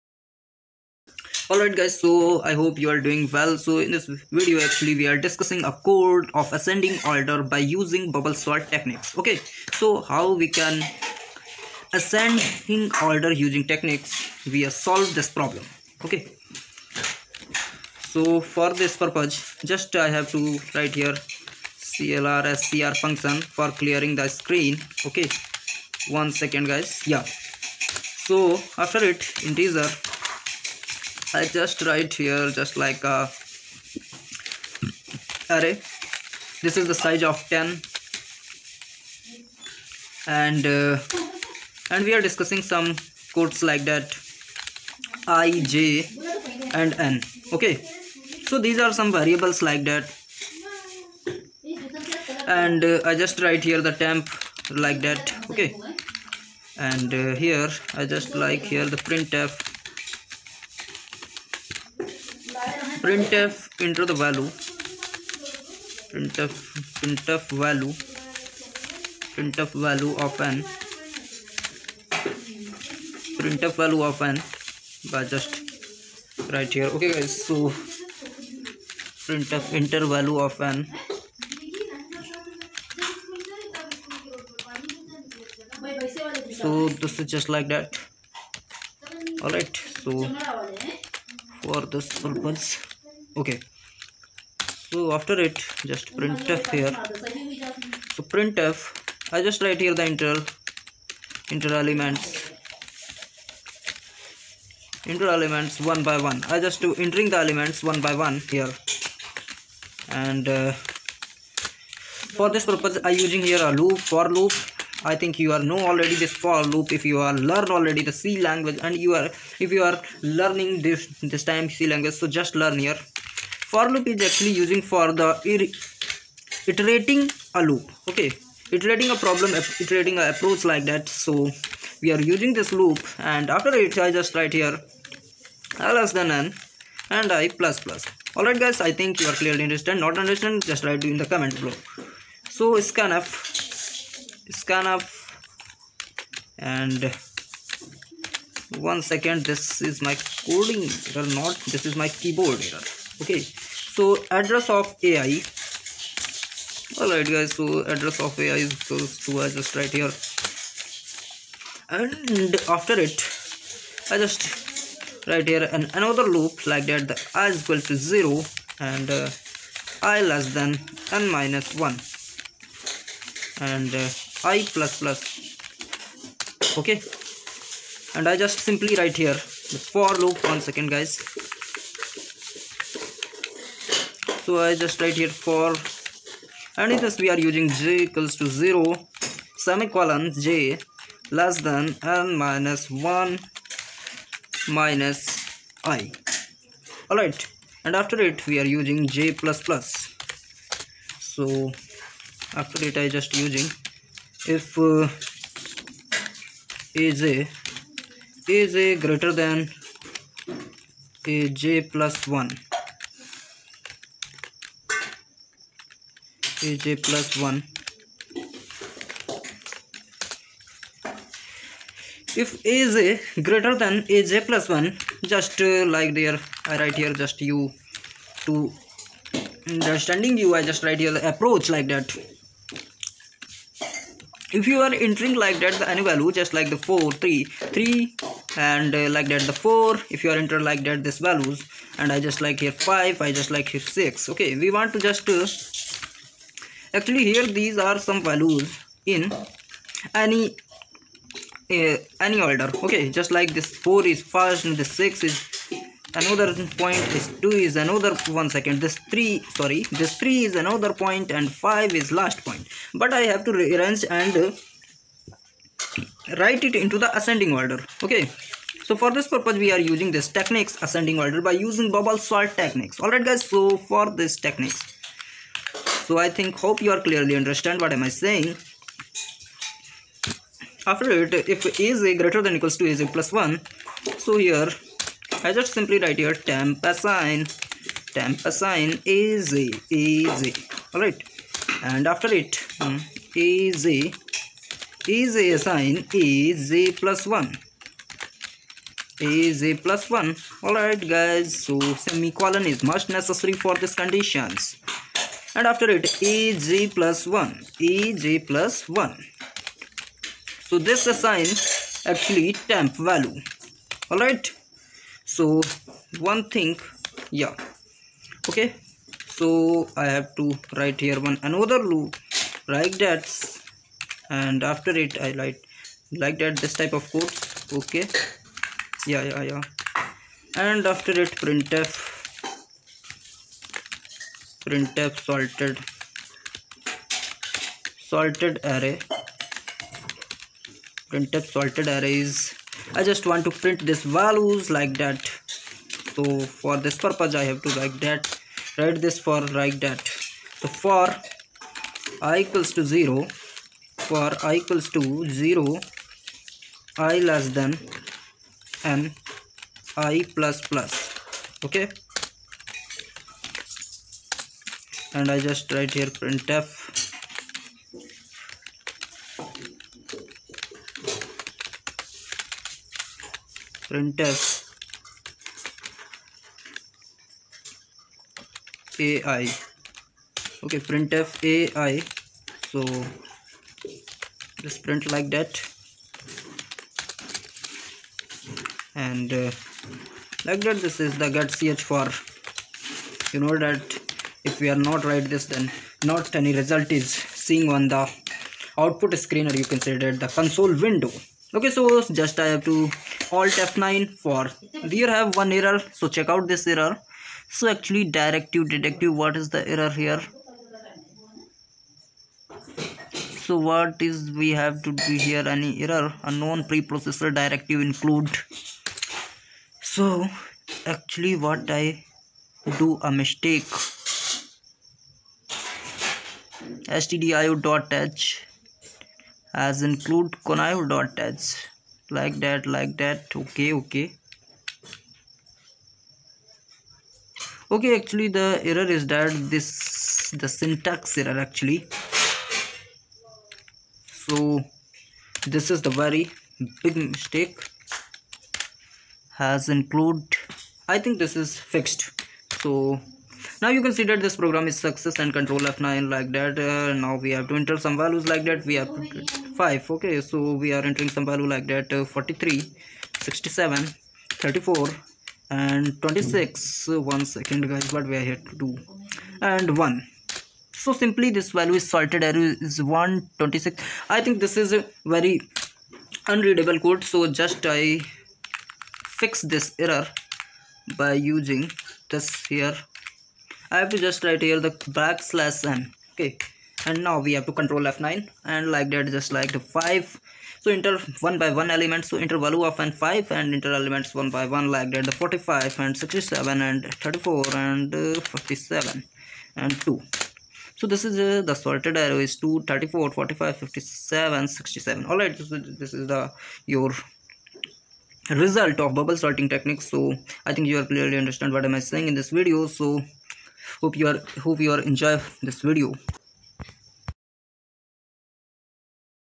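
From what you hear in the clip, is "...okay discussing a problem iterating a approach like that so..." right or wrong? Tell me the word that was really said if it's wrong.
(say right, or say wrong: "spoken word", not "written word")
wrong: "iterating", not "discussing".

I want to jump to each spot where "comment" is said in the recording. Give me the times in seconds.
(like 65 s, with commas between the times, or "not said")
141 s.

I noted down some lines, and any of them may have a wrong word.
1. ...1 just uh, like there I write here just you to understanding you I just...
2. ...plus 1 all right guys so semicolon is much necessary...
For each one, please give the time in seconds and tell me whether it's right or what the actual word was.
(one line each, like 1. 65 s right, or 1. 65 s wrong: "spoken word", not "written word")
1. 224 s right
2. 300 s right.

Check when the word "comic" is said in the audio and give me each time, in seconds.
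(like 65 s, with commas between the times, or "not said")
not said.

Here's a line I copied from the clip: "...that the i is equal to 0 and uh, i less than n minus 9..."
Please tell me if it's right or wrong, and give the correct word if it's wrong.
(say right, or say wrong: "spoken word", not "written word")
wrong: "1", not "9".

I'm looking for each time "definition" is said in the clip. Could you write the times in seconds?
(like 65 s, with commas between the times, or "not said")
not said.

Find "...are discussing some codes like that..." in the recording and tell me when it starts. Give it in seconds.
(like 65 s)
42 s.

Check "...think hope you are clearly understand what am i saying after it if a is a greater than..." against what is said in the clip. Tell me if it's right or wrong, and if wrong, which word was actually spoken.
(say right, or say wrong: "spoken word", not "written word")
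right.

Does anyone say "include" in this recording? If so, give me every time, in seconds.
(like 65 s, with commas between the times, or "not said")
417 s, 429 s, 449 s.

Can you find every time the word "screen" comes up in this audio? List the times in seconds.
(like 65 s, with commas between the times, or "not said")
24 s, 399 s.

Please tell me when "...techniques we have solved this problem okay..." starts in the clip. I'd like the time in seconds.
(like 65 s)
13 s.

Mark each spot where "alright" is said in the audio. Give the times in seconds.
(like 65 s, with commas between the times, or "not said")
1 s, 157 s, 272 s.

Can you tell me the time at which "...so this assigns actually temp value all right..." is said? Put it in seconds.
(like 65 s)
310 s.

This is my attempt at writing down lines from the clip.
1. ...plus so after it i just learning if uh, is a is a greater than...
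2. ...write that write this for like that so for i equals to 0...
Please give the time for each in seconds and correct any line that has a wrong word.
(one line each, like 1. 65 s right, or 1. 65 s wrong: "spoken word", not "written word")
1. 199 s wrong: "using", not "learning"
2. 347 s right.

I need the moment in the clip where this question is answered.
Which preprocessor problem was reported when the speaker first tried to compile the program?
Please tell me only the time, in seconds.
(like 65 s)
416 s.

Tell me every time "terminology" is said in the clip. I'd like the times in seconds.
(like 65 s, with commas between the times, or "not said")
not said.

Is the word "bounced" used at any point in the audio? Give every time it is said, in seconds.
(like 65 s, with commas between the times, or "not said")
not said.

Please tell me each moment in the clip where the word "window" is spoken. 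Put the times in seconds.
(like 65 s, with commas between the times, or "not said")
400 s.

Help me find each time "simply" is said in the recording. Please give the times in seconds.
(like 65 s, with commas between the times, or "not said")
178 s, 285 s, 471 s.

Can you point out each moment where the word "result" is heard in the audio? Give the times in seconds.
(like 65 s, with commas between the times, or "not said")
396 s, 508 s.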